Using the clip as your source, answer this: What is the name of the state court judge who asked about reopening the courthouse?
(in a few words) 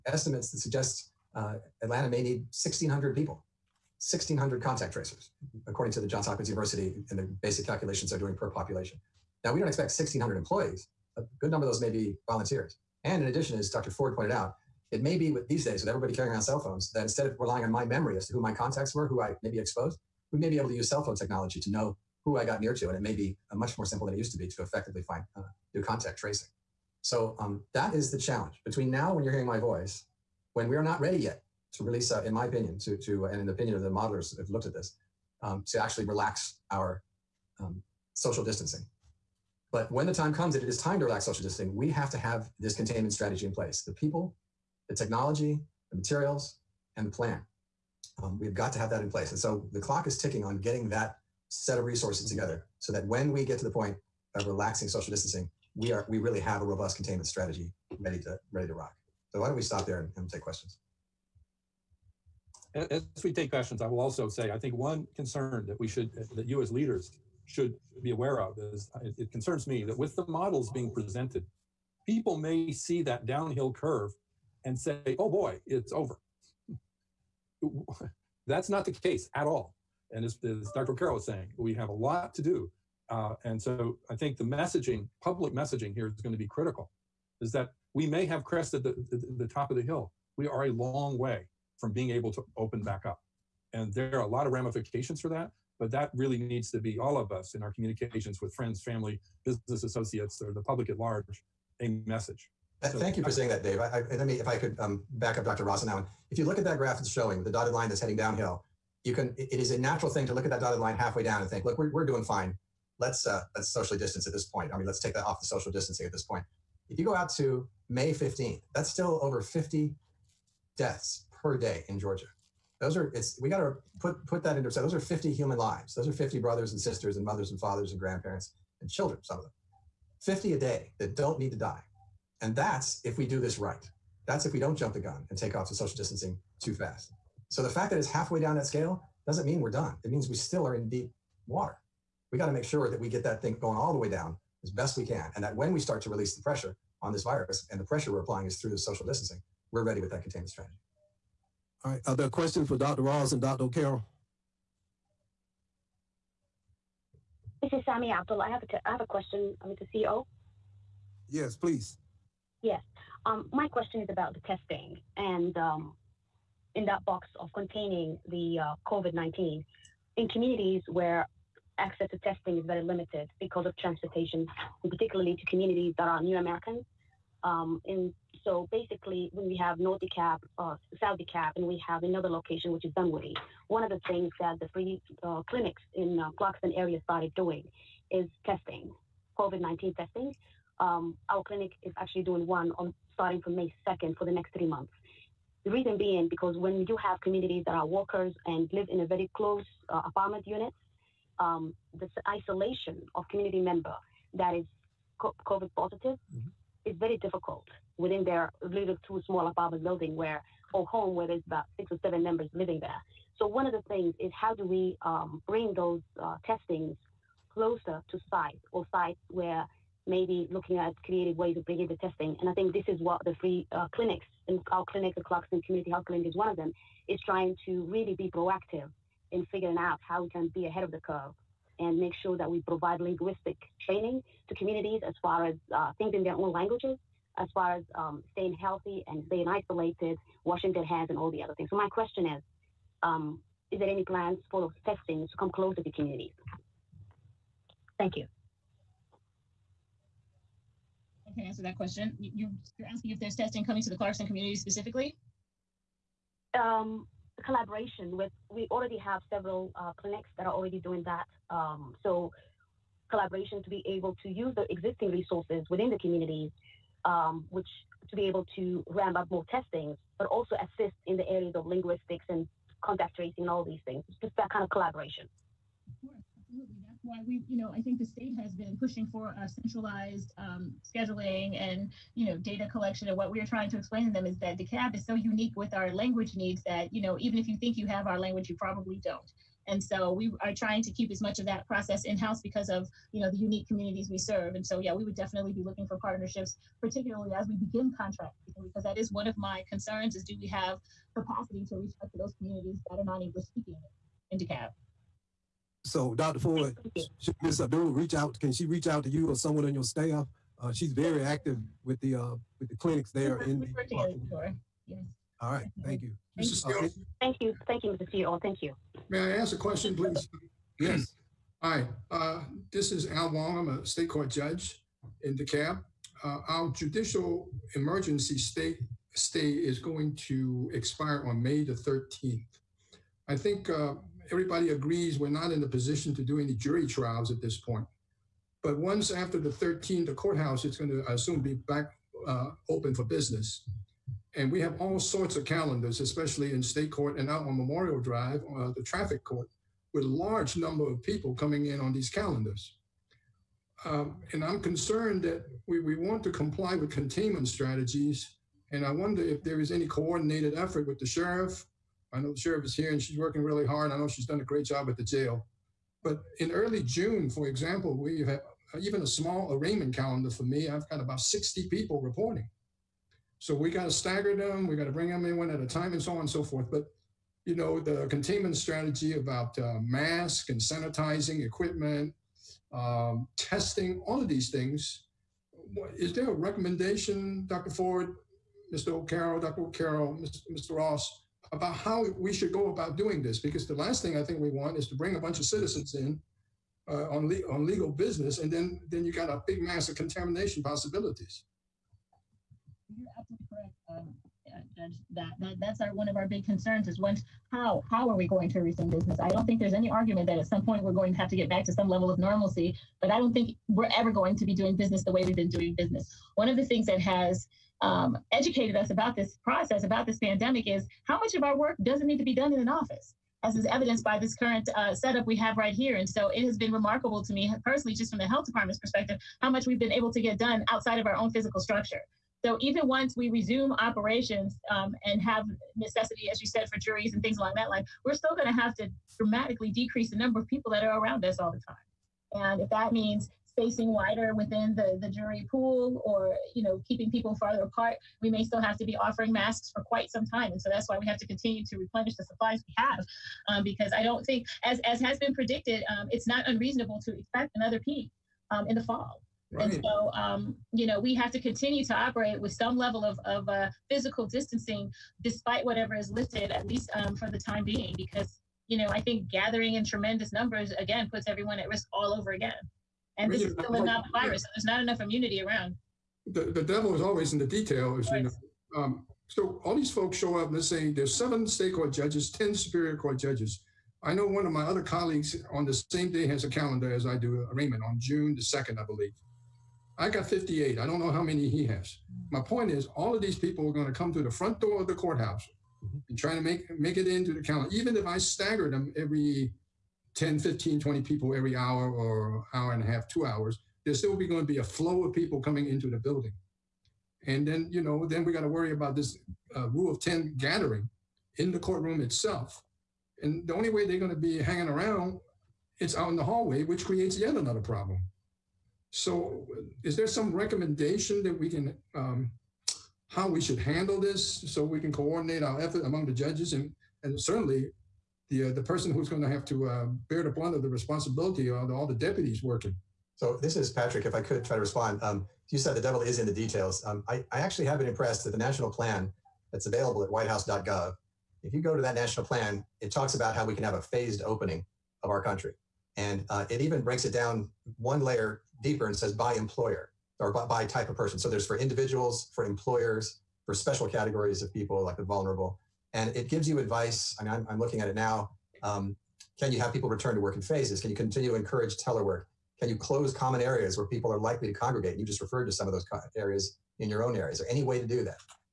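Al Wong.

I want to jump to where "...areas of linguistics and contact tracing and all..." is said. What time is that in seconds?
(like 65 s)
271 s.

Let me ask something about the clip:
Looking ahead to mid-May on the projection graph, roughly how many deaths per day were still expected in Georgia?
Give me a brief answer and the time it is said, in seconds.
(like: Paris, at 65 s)
Over 50, at 119 s.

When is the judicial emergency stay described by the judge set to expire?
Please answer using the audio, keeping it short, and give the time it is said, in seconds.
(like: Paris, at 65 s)
May 13, at 331 s.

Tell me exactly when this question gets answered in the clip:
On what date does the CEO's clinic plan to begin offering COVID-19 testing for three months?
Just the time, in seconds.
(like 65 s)
193 s.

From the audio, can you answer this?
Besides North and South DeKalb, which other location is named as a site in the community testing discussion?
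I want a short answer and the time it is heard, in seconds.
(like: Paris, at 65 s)
Dunwoody, at 182 s.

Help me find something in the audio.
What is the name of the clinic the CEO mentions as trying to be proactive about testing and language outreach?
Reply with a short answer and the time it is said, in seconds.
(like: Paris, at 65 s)
Clarkston Community Health Clinic, at 225 s.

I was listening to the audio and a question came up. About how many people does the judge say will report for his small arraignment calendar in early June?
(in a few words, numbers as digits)
About 60.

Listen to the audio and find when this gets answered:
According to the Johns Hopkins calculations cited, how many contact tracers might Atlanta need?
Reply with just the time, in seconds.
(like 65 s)
4 s.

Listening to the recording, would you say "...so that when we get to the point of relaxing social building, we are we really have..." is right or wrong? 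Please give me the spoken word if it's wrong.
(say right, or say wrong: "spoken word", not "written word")
wrong: "distancing", not "building".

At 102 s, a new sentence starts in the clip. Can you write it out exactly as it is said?
Uh, so, Thank you for saying that, Dave.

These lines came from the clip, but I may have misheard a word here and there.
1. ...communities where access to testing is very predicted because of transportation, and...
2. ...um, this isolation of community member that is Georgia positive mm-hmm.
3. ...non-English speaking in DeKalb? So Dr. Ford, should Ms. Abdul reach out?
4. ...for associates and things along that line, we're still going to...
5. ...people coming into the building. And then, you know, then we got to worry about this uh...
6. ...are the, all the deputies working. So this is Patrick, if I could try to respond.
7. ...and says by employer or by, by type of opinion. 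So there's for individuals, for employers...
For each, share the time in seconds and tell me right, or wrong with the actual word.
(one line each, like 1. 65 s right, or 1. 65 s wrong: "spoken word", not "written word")
1. 170 s wrong: "limited", not "predicted"
2. 201 s wrong: "COVID", not "Georgia"
3. 303 s right
4. 436 s wrong: "juries", not "associates"
5. 505 s right
6. 531 s right
7. 548 s wrong: "person", not "opinion".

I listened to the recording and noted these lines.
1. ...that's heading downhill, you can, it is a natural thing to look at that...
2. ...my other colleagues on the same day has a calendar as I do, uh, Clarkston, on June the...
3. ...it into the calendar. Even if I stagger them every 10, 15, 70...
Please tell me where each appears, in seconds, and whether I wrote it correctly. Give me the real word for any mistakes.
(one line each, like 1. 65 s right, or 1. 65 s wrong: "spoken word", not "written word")
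1. 107 s right
2. 484 s wrong: "Raymond", not "Clarkston"
3. 496 s wrong: "20", not "70".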